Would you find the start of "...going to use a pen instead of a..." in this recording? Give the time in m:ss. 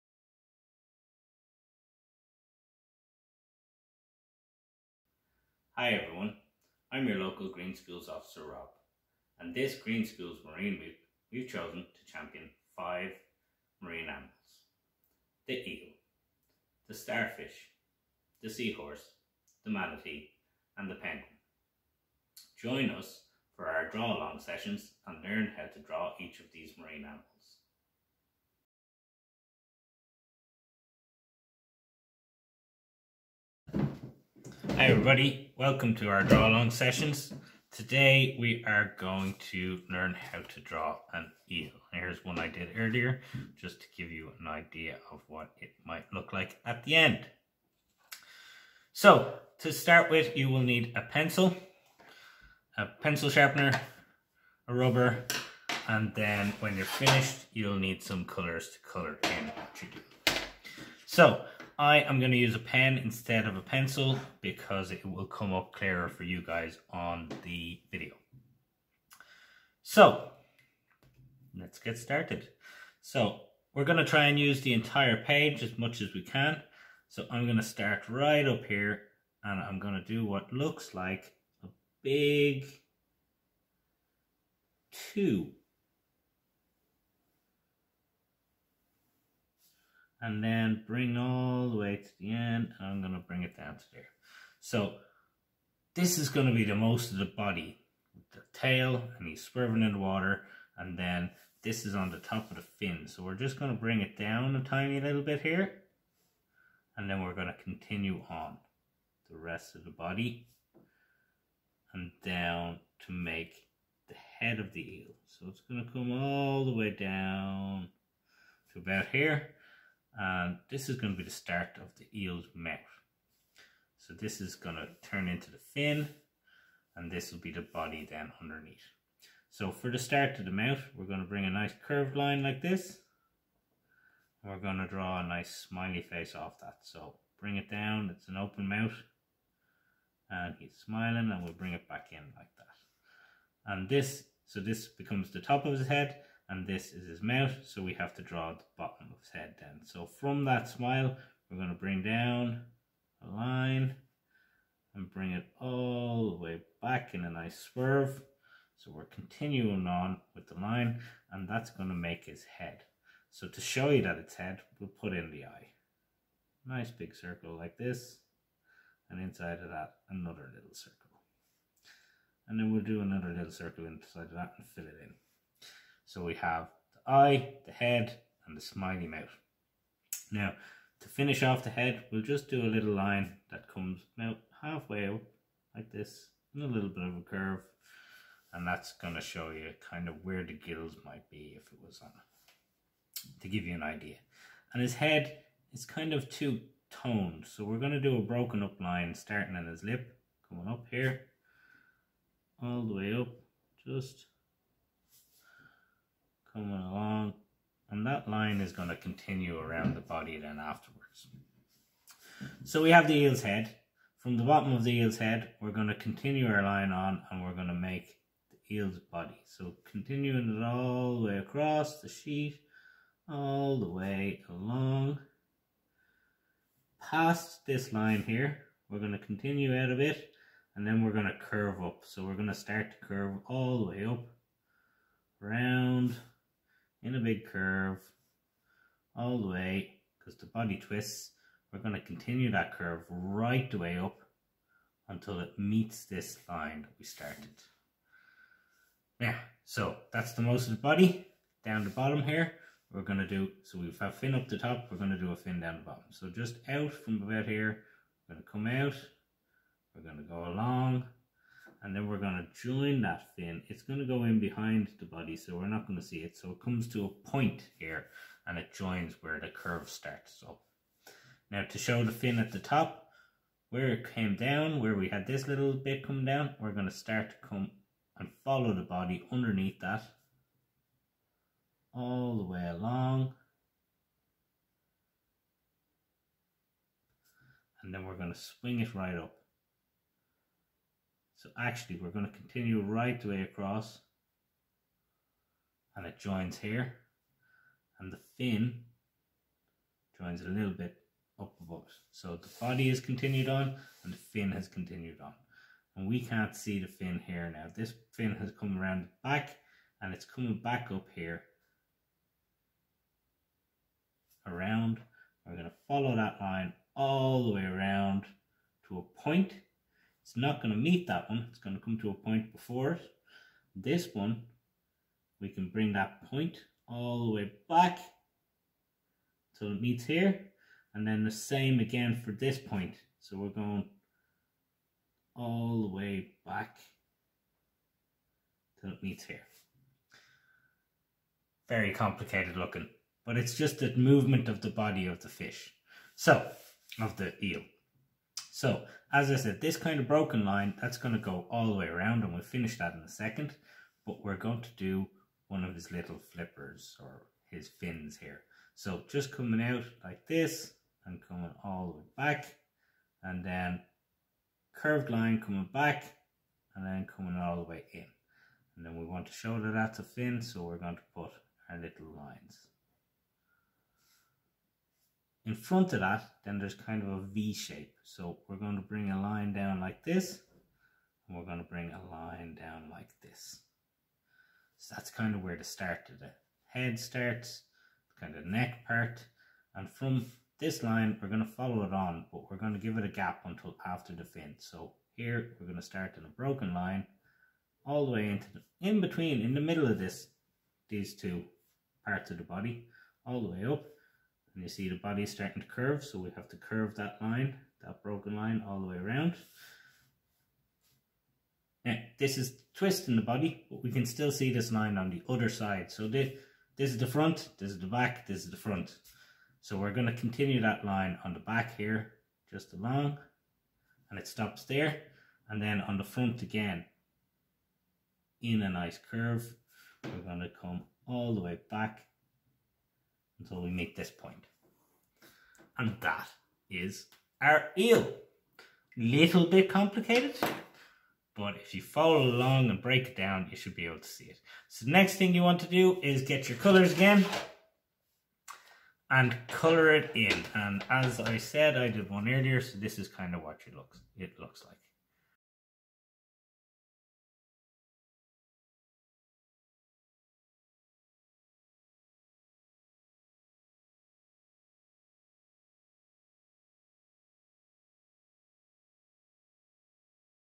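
1:02.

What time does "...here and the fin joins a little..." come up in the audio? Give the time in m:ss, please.
4:56.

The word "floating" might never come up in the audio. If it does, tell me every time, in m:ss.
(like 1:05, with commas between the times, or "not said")
not said.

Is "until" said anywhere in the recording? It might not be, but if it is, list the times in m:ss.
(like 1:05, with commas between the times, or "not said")
4:05, 6:33, 7:13.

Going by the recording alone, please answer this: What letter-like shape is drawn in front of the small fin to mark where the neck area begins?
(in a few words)
V.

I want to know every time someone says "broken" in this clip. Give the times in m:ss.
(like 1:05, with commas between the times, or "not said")
3:18, 5:50, 6:36, 6:48.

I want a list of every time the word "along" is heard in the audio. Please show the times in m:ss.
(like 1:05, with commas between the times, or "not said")
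0:23, 0:36, 3:26, 3:44, 4:20, 4:42, 7:02, 7:22.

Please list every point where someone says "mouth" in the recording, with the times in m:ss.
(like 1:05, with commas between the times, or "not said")
2:02, 2:10, 2:18, 2:27, 2:59.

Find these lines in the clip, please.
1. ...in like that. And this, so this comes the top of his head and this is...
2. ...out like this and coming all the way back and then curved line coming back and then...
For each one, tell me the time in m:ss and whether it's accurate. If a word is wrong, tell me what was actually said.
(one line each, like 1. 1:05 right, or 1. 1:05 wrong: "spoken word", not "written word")
1. 2:22 wrong: "becomes", not "comes"
2. 5:59 right.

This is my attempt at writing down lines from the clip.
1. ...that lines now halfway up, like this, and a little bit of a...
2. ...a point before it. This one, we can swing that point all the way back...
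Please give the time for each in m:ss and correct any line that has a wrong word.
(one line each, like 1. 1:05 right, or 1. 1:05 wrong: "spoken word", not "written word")
1. 3:03 wrong: "comes", not "lines"
2. 5:22 wrong: "bring", not "swing".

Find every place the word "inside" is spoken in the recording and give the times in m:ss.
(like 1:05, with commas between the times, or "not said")
2:49, 2:53.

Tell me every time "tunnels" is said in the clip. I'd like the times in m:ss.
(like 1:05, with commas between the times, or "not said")
not said.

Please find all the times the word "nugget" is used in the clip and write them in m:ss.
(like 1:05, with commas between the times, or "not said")
not said.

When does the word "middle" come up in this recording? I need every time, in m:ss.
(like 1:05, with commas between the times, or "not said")
6:39.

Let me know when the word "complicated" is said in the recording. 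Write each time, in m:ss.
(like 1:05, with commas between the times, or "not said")
5:41, 7:19.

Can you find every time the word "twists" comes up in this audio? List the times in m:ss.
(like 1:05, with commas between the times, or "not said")
4:00, 6:52.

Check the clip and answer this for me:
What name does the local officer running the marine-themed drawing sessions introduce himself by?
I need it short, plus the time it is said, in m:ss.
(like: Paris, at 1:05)
Rob, at 0:08.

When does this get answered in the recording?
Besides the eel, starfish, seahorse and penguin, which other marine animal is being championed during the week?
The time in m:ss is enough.
0:19.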